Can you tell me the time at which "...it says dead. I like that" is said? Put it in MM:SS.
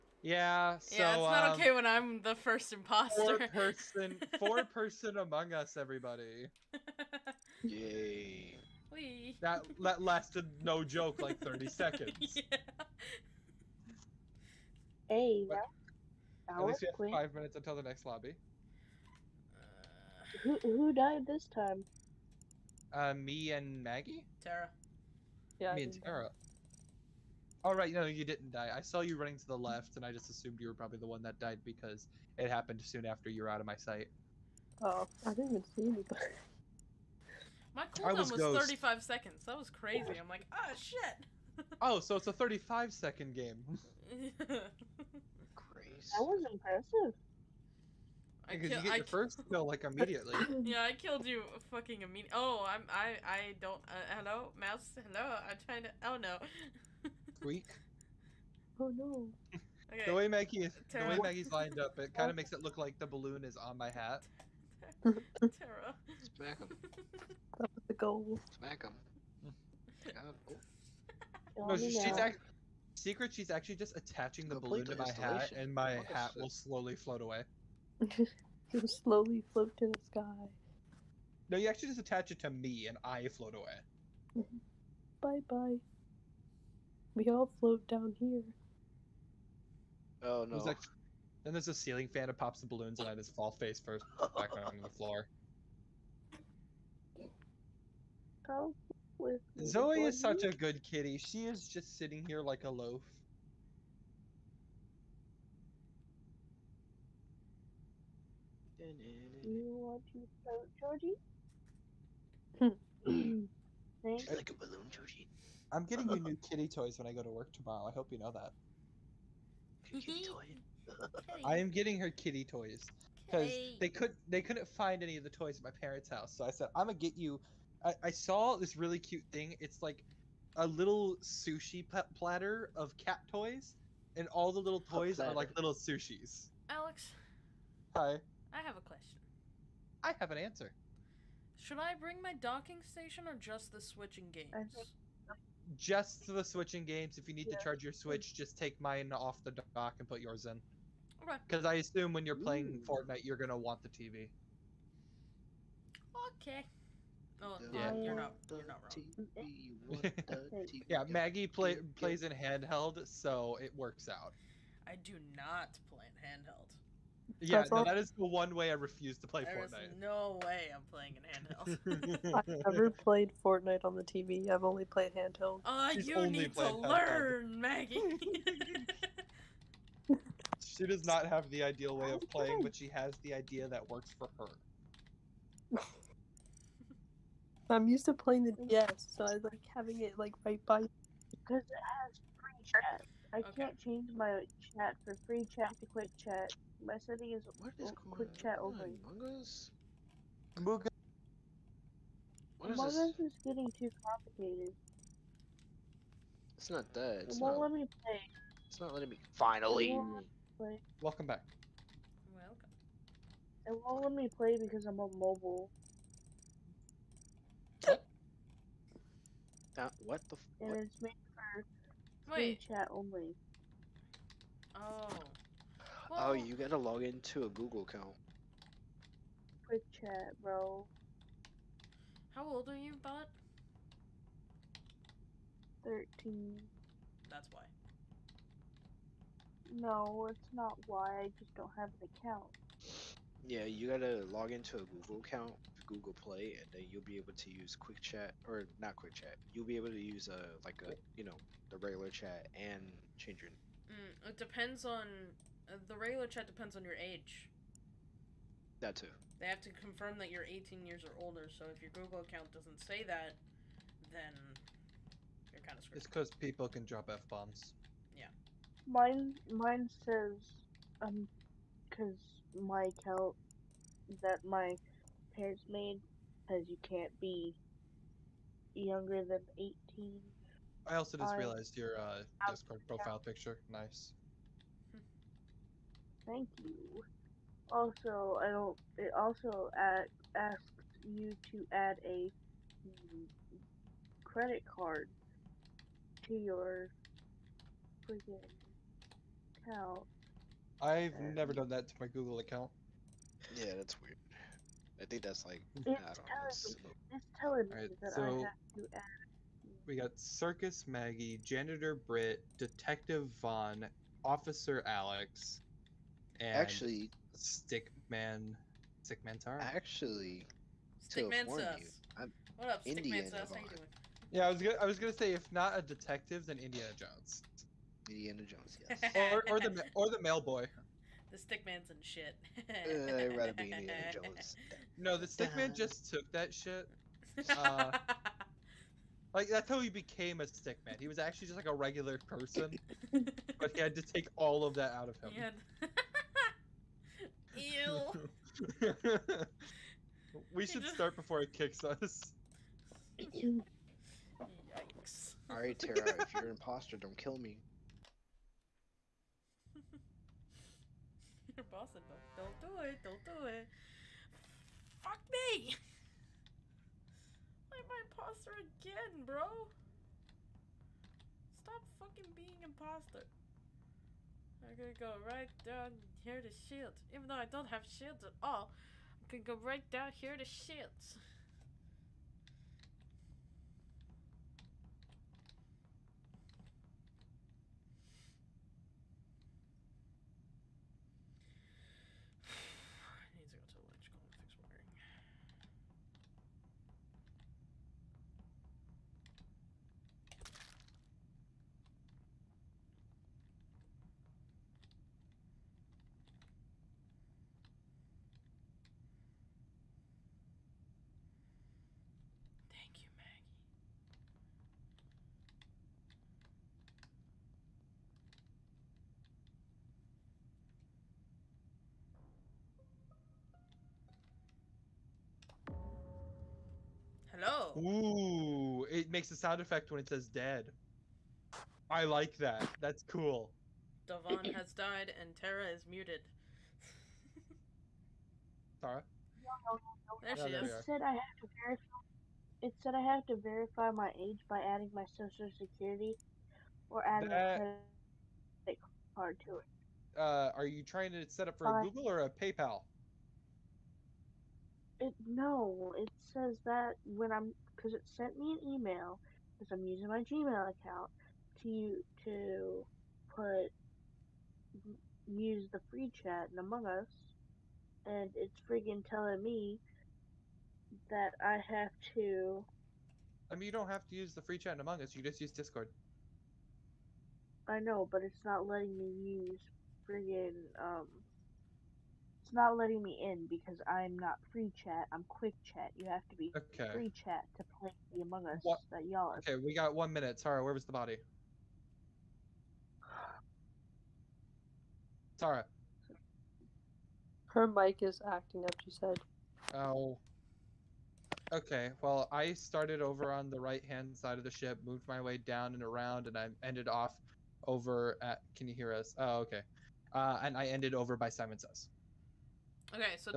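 07:09.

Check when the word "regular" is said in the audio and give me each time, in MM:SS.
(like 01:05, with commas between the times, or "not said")
04:11, 04:15, 05:41.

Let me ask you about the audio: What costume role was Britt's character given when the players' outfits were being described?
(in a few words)
Janitor.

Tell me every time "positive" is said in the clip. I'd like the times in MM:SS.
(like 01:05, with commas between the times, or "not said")
not said.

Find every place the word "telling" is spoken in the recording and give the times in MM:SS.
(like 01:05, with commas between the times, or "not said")
05:07, 07:49.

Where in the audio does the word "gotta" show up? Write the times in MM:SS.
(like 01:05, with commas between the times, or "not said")
03:46, 04:03.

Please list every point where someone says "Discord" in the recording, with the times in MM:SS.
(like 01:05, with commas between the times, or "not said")
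04:42, 07:55.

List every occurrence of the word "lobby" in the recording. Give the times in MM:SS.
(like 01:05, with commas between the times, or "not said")
00:18.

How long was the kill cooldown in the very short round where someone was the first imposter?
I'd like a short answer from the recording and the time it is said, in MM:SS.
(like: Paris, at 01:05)
35 seconds, at 00:38.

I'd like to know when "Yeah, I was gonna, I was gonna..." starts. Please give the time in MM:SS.
05:24.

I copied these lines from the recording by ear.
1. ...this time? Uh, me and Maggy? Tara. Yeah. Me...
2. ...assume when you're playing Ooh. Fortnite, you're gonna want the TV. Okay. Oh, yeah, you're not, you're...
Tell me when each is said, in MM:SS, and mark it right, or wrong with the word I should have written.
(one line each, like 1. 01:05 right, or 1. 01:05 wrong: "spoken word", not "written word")
1. 00:21 right
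2. 02:31 right.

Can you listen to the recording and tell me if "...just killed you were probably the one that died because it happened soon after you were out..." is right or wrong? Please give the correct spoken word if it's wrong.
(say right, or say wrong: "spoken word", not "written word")
wrong: "assumed", not "killed".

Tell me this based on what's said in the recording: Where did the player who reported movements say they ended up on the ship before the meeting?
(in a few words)
Simon Says.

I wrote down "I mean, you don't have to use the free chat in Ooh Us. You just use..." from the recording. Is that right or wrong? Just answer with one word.
wrong.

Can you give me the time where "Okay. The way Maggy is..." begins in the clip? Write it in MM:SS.
00:59.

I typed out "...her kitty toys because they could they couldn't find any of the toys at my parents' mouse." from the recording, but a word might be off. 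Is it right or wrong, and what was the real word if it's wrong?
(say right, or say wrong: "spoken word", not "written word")
wrong: "house", not "mouse".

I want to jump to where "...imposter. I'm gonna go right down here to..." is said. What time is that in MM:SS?
06:12.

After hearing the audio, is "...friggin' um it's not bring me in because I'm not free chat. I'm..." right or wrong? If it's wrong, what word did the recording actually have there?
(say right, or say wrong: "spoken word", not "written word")
wrong: "letting", not "bring".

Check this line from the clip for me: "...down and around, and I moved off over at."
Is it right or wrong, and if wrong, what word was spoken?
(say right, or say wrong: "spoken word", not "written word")
wrong: "ended", not "moved".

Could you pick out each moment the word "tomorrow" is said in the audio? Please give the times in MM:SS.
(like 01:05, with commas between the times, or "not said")
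01:57.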